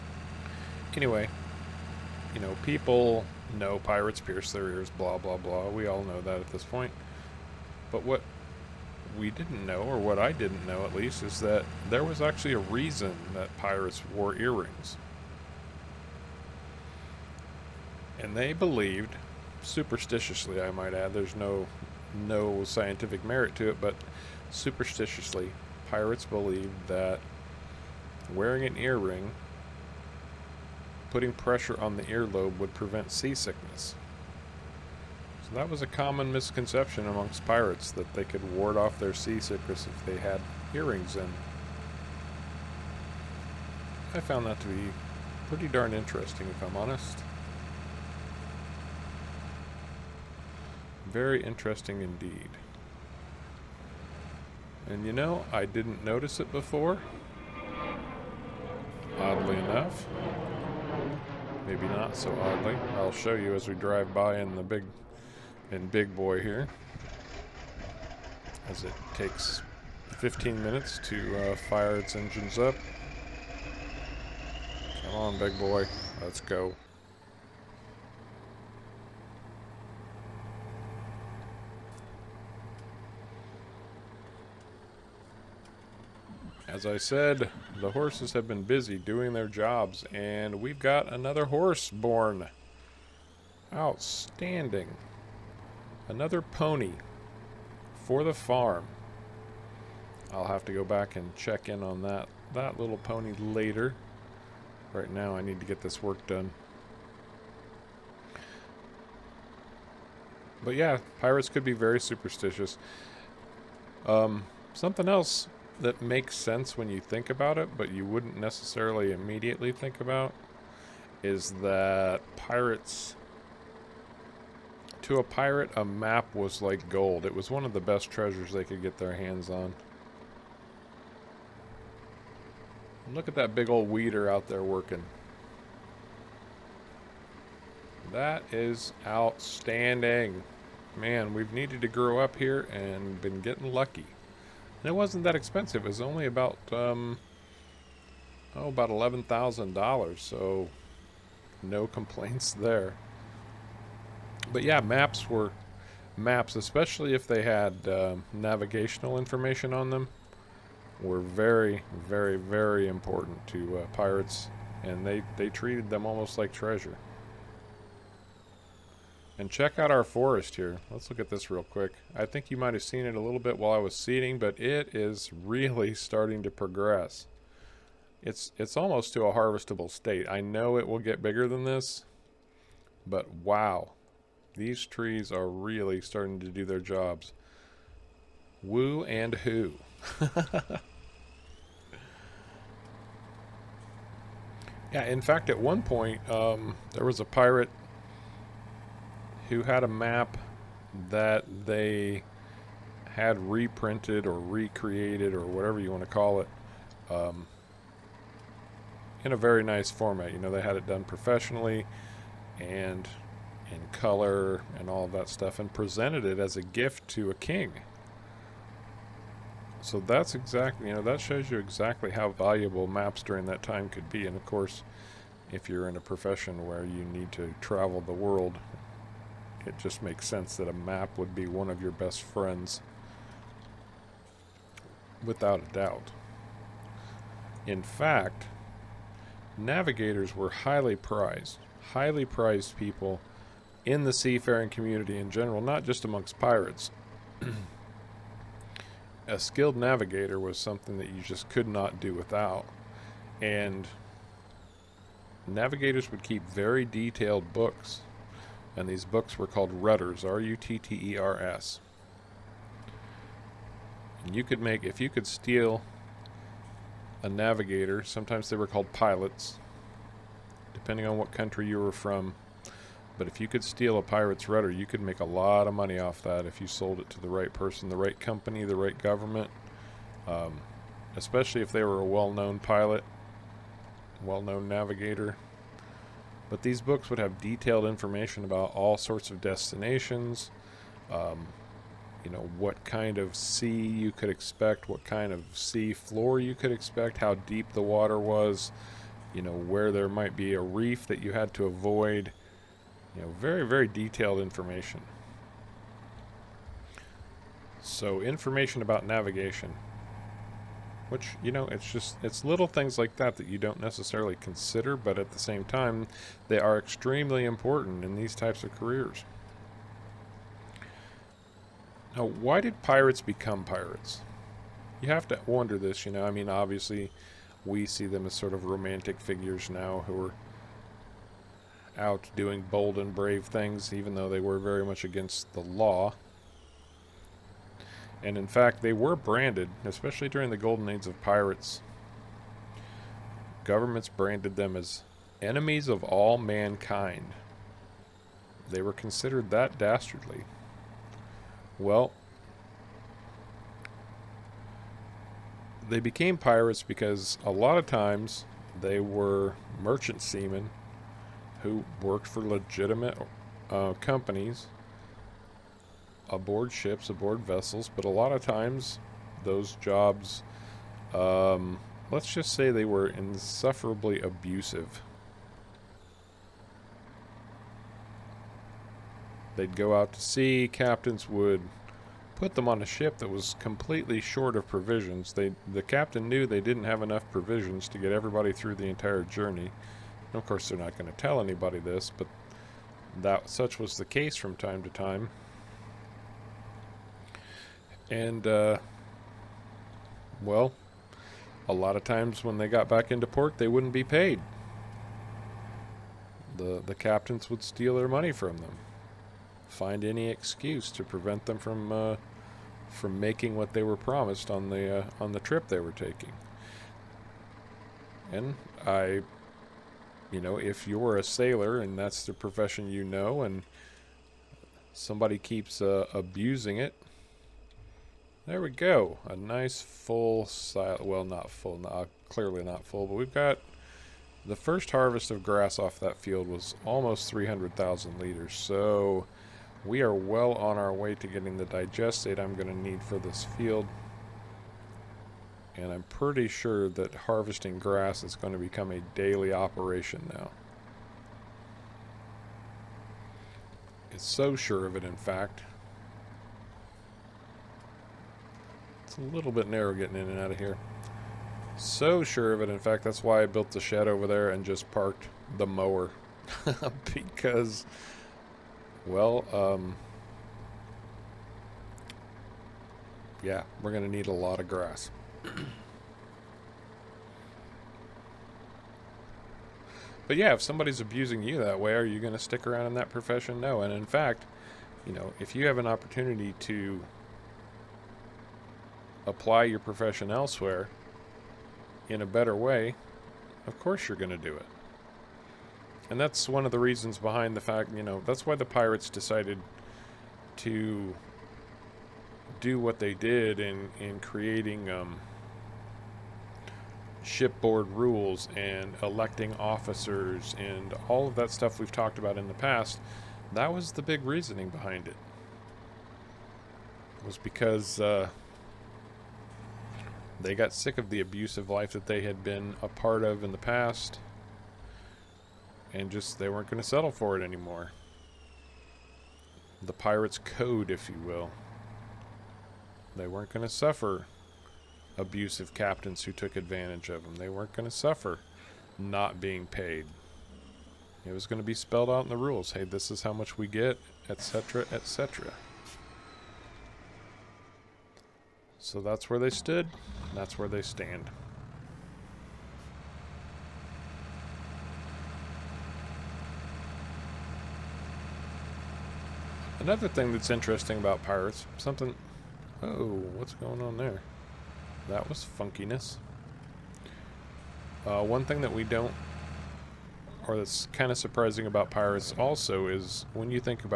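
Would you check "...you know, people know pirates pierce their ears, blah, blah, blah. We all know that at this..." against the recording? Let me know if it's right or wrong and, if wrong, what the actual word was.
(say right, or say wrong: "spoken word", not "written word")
right.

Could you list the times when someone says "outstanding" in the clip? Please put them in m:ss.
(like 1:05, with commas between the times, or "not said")
1:33, 2:19.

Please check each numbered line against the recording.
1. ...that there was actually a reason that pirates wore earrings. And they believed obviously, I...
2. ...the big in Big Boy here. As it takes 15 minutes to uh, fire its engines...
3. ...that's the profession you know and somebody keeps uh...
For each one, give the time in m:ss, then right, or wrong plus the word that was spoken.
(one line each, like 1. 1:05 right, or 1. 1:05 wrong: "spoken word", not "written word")
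1. 0:11 wrong: "superstitiously", not "obviously"
2. 1:04 right
3. 7:01 right.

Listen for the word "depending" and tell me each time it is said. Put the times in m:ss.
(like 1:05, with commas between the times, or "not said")
4:30.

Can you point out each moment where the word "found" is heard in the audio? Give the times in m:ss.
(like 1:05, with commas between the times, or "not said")
0:44.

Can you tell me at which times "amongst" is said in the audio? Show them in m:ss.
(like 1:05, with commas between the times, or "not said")
0:37, 4:06.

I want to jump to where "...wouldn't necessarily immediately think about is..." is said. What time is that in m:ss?
1:58.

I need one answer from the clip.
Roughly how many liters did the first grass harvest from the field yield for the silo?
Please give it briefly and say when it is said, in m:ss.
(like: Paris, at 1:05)
300,000 liters, at 7:17.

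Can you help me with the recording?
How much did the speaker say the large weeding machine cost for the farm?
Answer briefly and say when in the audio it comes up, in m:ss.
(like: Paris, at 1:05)
$11,000, at 2:28.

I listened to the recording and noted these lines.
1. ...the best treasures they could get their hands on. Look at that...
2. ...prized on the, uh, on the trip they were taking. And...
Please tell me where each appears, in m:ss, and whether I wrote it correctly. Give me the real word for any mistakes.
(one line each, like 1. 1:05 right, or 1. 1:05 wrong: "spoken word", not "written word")
1. 2:07 right
2. 6:53 wrong: "promised", not "prized".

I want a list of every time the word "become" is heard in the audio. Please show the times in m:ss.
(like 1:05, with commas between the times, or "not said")
5:23, 7:28.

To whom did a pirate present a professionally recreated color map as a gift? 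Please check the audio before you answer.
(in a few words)
A king.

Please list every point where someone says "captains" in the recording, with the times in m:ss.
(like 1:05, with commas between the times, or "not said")
6:20, 6:25, 6:46, 8:55.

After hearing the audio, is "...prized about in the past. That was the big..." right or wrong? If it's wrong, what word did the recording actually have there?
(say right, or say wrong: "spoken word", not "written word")
wrong: "talked", not "prized".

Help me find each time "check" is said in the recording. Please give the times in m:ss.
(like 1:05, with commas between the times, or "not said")
1:41, 2:49.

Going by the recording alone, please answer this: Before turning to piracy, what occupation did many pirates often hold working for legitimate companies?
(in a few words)
Merchant seamen.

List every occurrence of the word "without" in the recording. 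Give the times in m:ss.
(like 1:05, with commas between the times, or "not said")
3:55, 4:12.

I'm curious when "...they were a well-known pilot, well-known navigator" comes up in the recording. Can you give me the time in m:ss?
4:41.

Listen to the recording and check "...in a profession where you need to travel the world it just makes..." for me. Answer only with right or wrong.
right.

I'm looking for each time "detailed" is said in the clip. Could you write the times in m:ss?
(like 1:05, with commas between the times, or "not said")
4:16, 4:47, 5:03.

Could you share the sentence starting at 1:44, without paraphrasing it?
Right now, I need to get this work done.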